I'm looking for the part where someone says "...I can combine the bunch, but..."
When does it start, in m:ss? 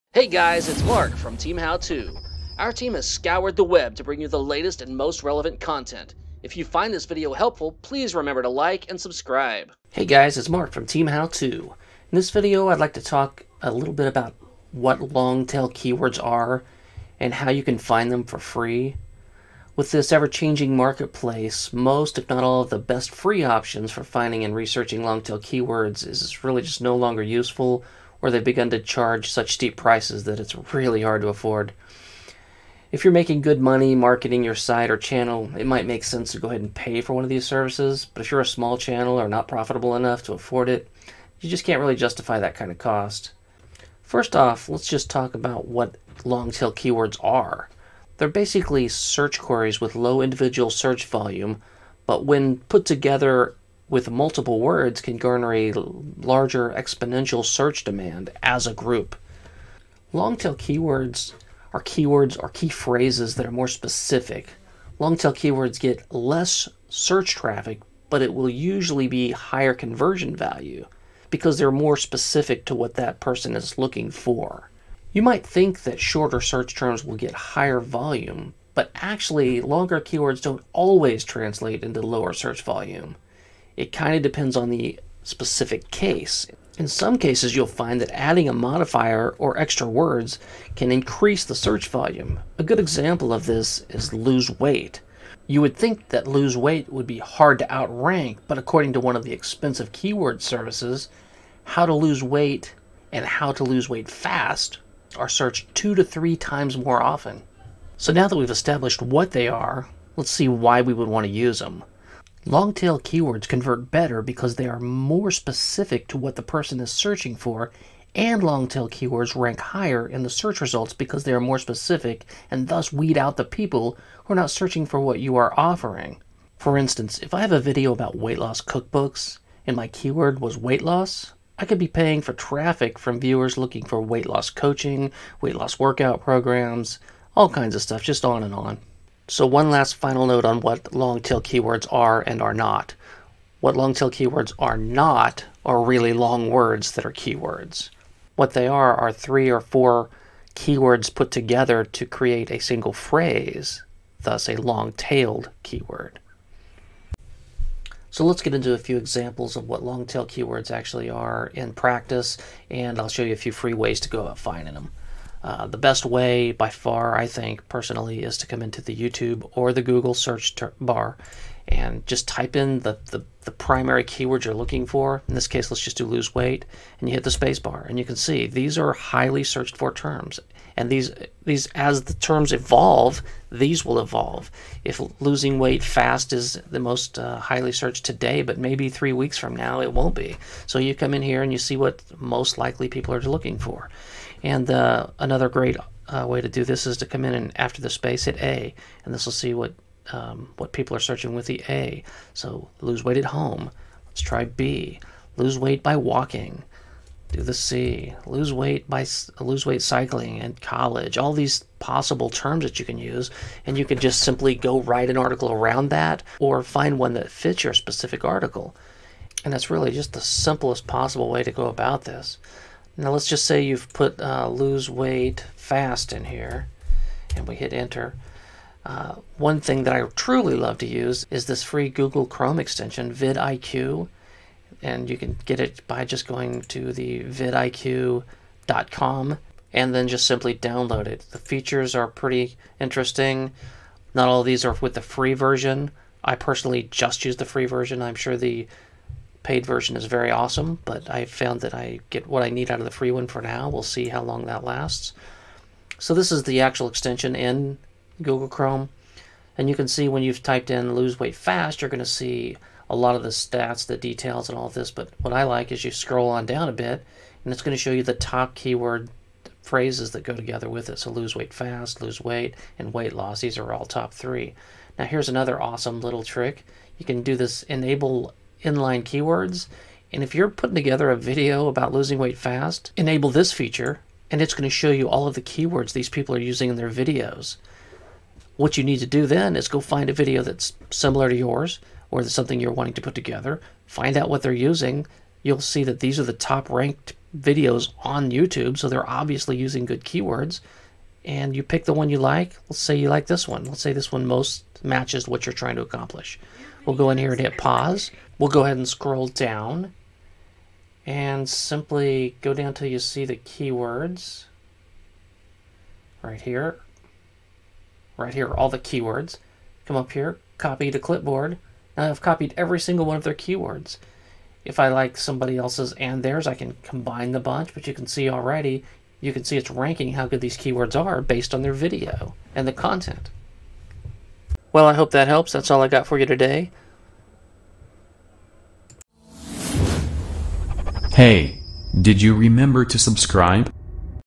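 5:26.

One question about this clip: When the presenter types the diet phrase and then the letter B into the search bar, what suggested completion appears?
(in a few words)
Lose weight by walking.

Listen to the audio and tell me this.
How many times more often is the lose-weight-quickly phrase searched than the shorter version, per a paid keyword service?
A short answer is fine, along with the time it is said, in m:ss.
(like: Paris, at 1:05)
2 to 3 times, at 1:45.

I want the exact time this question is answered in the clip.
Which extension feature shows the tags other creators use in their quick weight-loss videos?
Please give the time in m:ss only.
4:37.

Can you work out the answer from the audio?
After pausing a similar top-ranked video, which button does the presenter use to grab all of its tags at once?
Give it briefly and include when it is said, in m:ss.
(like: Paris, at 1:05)
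Copy to clipboard, at 5:20.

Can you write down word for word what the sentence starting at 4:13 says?
We'll see how long that lasts.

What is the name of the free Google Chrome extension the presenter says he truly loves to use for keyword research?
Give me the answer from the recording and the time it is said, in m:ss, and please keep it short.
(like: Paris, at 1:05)
vidIQ, at 3:53.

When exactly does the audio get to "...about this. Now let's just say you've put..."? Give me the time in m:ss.
3:41.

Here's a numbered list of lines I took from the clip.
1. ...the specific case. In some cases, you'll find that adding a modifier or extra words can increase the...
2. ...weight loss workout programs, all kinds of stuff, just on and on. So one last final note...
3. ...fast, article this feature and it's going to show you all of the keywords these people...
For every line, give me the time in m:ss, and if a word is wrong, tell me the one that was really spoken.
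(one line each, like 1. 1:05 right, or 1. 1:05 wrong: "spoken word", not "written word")
1. 1:24 right
2. 2:15 right
3. 4:42 wrong: "enable", not "article".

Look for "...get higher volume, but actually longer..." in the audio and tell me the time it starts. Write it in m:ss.
1:17.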